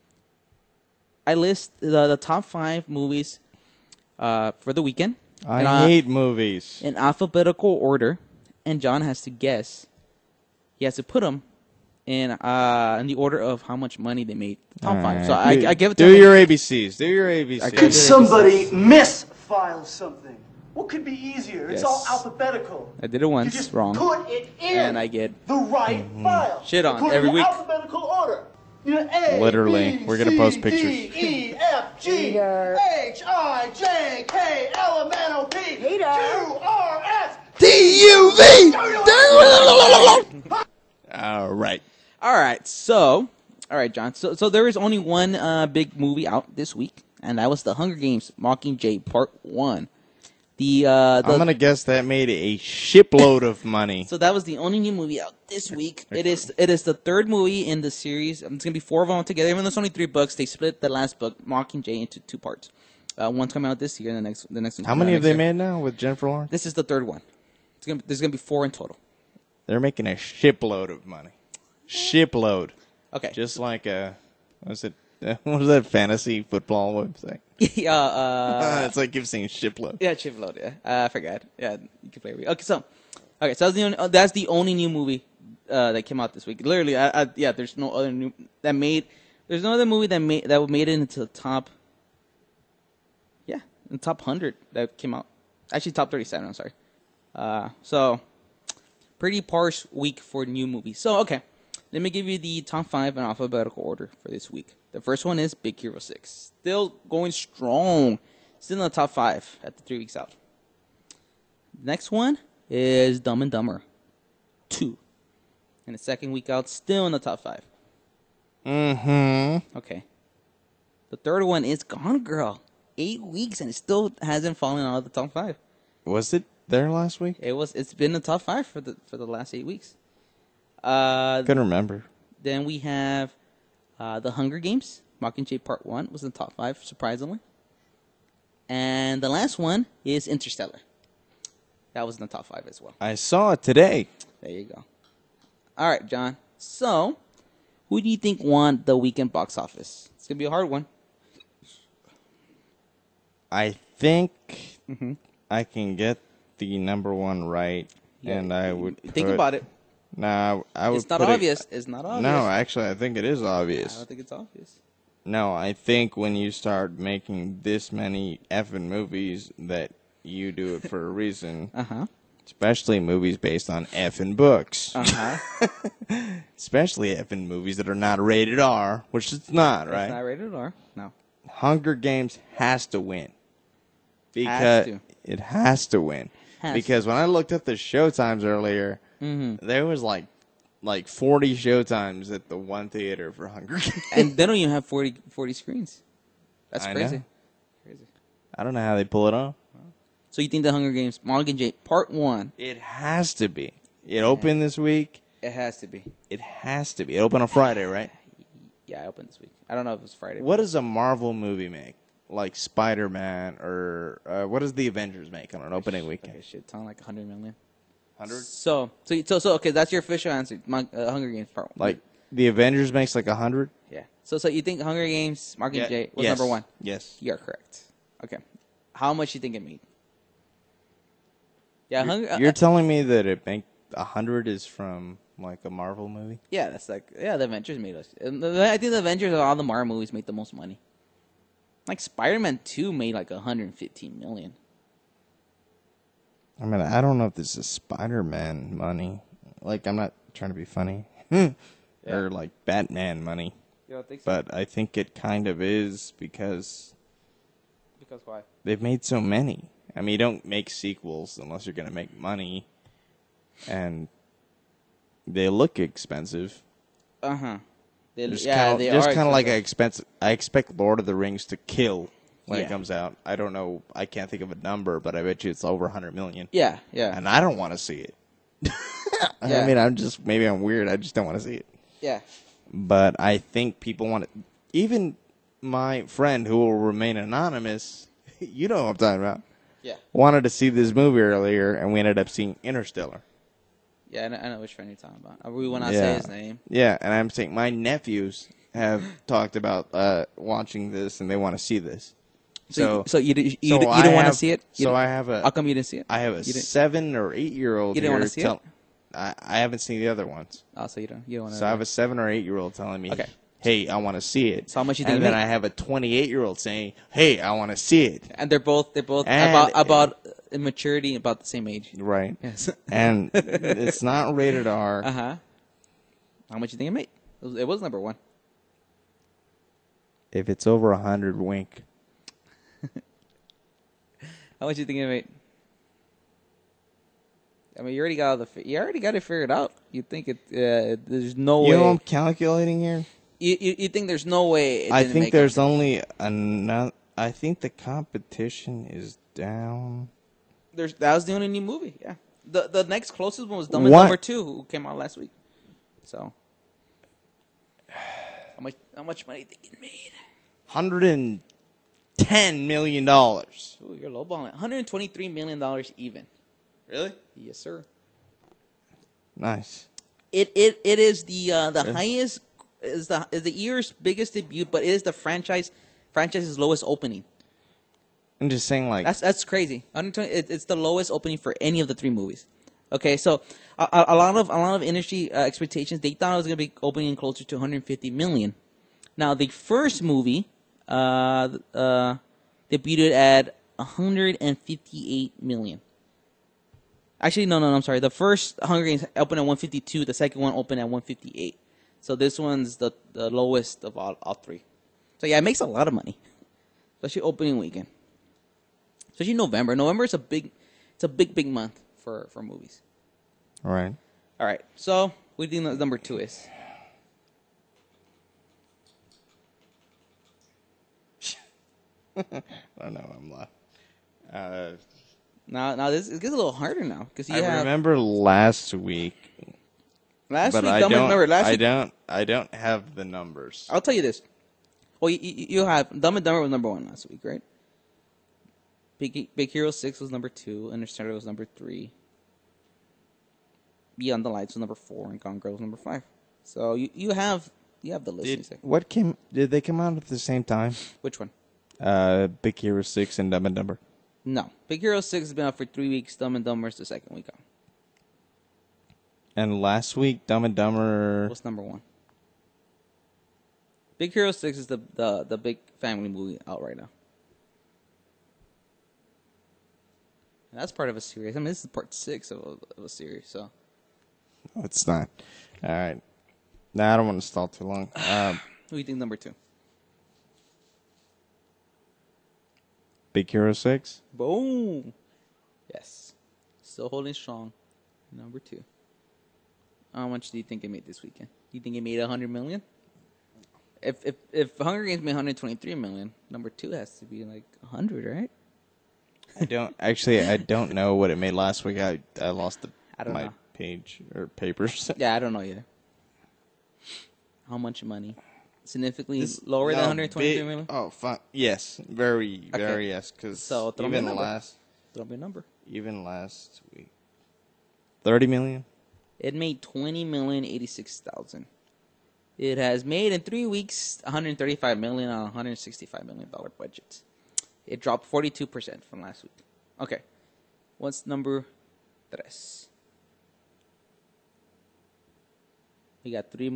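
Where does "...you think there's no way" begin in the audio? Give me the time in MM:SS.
05:43.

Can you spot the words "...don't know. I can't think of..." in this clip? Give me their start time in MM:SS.
04:33.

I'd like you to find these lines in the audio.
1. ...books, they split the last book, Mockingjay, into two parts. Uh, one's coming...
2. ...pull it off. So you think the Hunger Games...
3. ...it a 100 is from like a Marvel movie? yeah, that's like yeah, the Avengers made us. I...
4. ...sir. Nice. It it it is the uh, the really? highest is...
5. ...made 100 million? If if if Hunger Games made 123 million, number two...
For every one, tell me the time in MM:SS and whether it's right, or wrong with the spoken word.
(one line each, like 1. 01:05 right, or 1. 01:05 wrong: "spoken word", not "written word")
1. 01:00 right
2. 03:19 right
3. 03:53 right
4. 06:07 right
5. 08:11 right.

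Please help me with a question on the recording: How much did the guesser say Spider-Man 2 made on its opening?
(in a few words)
115 million.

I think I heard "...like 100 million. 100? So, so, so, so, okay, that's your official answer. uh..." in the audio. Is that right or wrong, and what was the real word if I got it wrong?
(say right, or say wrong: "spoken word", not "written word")
right.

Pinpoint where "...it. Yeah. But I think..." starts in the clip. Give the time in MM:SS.
04:41.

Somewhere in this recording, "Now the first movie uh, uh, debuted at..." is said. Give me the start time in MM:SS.
06:29.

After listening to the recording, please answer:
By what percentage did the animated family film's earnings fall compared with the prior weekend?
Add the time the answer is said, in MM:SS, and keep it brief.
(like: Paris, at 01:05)
42 percent, at 08:48.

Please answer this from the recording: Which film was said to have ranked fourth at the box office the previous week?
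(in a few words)
Beyond the Lights.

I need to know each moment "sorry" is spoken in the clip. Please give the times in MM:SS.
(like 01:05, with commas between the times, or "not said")
01:36, 06:37.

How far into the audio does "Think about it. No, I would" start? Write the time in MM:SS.
02:39.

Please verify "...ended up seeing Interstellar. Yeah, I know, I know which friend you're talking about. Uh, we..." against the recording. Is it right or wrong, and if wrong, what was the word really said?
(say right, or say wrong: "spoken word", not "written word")
right.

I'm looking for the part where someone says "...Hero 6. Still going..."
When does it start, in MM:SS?
01:45.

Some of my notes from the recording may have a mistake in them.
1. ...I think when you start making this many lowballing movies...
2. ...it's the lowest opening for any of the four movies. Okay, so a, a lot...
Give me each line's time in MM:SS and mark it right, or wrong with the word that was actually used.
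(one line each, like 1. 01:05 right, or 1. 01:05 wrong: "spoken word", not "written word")
1. 02:45 wrong: "effing", not "lowballing"
2. 06:20 wrong: "three", not "four".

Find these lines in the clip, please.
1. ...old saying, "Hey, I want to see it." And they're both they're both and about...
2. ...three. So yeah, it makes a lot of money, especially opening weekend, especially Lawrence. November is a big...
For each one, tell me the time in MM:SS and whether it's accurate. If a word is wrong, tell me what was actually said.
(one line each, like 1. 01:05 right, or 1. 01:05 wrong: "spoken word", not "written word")
1. 05:16 right
2. 06:44 wrong: "November", not "Lawrence".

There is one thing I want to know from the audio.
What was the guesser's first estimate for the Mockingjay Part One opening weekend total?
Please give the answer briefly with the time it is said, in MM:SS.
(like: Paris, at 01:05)
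110 million dollars, at 06:00.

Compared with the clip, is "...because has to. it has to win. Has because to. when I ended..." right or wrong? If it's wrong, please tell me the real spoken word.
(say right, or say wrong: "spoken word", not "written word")
wrong: "looked", not "ended".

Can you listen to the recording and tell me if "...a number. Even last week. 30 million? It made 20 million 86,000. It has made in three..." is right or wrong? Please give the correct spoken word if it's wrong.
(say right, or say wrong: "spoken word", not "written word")
right.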